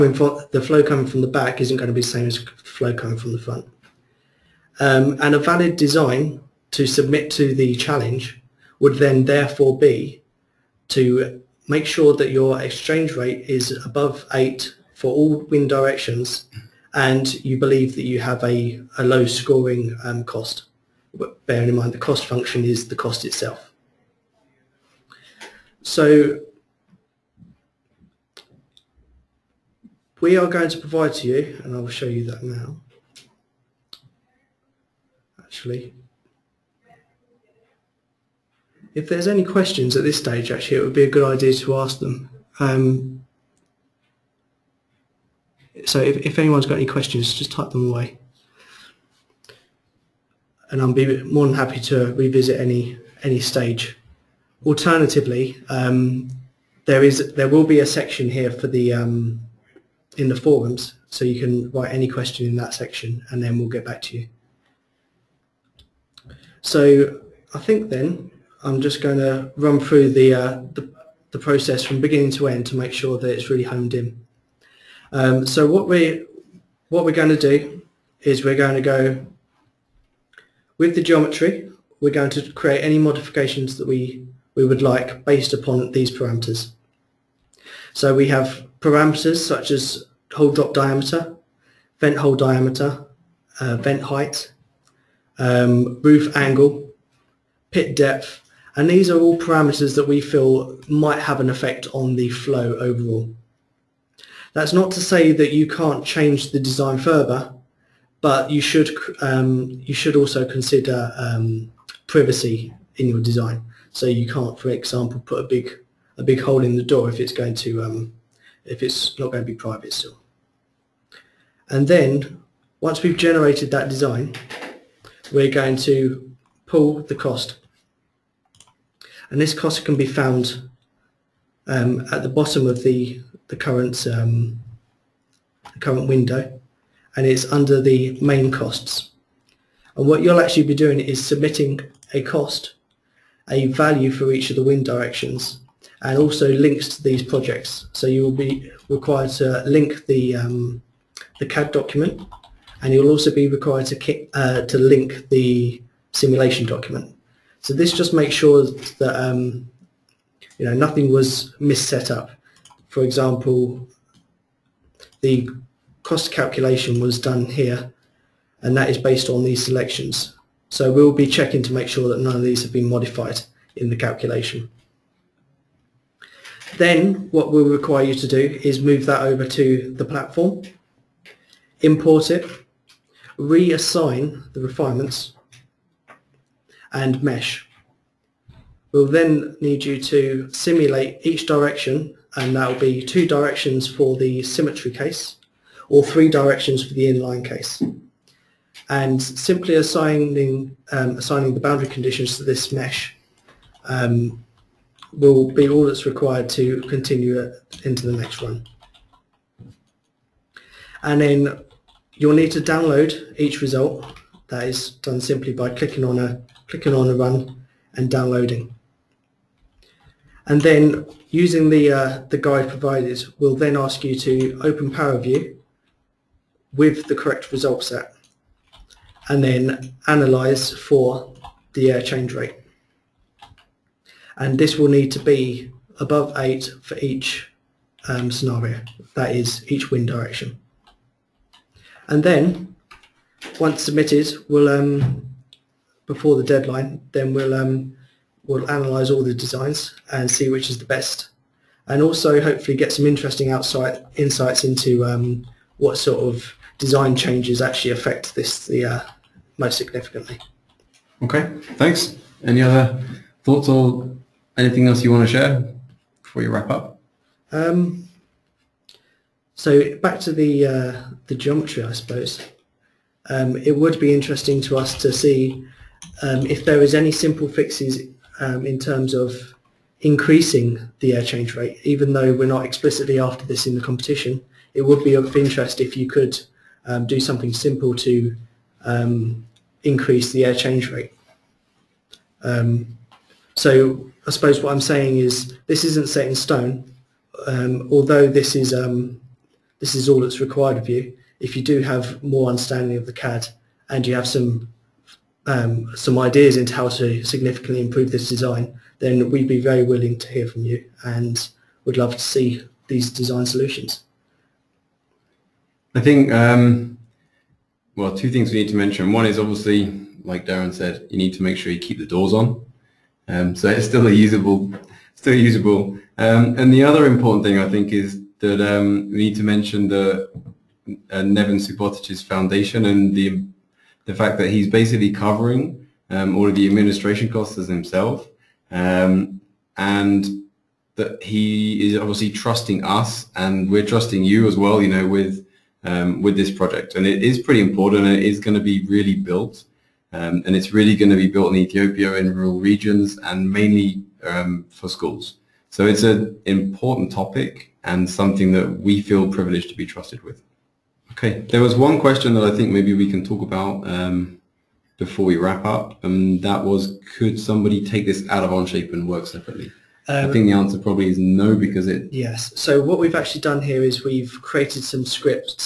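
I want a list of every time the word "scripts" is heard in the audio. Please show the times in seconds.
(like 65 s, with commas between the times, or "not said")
375 s.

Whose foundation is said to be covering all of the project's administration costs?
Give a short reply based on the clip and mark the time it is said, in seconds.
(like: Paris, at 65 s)
Neven Subotic, at 331 s.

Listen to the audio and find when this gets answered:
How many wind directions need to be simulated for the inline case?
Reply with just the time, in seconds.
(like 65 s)
196 s.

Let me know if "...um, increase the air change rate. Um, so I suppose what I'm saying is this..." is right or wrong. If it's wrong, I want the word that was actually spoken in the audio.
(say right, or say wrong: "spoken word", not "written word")
right.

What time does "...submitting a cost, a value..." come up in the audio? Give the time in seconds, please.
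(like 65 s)
141 s.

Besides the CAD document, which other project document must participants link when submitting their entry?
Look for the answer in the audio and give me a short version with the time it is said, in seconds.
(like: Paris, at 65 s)
simulation document, at 156 s.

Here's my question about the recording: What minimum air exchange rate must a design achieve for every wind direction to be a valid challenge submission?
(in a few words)
8.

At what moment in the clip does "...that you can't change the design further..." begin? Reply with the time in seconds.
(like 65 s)
105 s.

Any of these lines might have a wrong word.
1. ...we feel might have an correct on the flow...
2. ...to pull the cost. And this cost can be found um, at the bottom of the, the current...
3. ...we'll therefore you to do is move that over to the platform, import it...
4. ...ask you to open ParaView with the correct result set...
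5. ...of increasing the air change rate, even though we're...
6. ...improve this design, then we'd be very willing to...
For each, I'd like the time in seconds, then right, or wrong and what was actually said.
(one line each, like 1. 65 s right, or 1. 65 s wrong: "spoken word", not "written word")
1. 100 s wrong: "effect", not "correct"
2. 125 s right
3. 177 s wrong: "require", not "therefore"
4. 223 s right
5. 279 s right
6. 307 s right.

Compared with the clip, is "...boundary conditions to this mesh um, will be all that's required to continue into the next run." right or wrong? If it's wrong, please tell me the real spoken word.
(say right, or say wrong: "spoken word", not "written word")
right.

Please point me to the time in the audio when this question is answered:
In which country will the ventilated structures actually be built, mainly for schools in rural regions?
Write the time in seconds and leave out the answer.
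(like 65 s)
351 s.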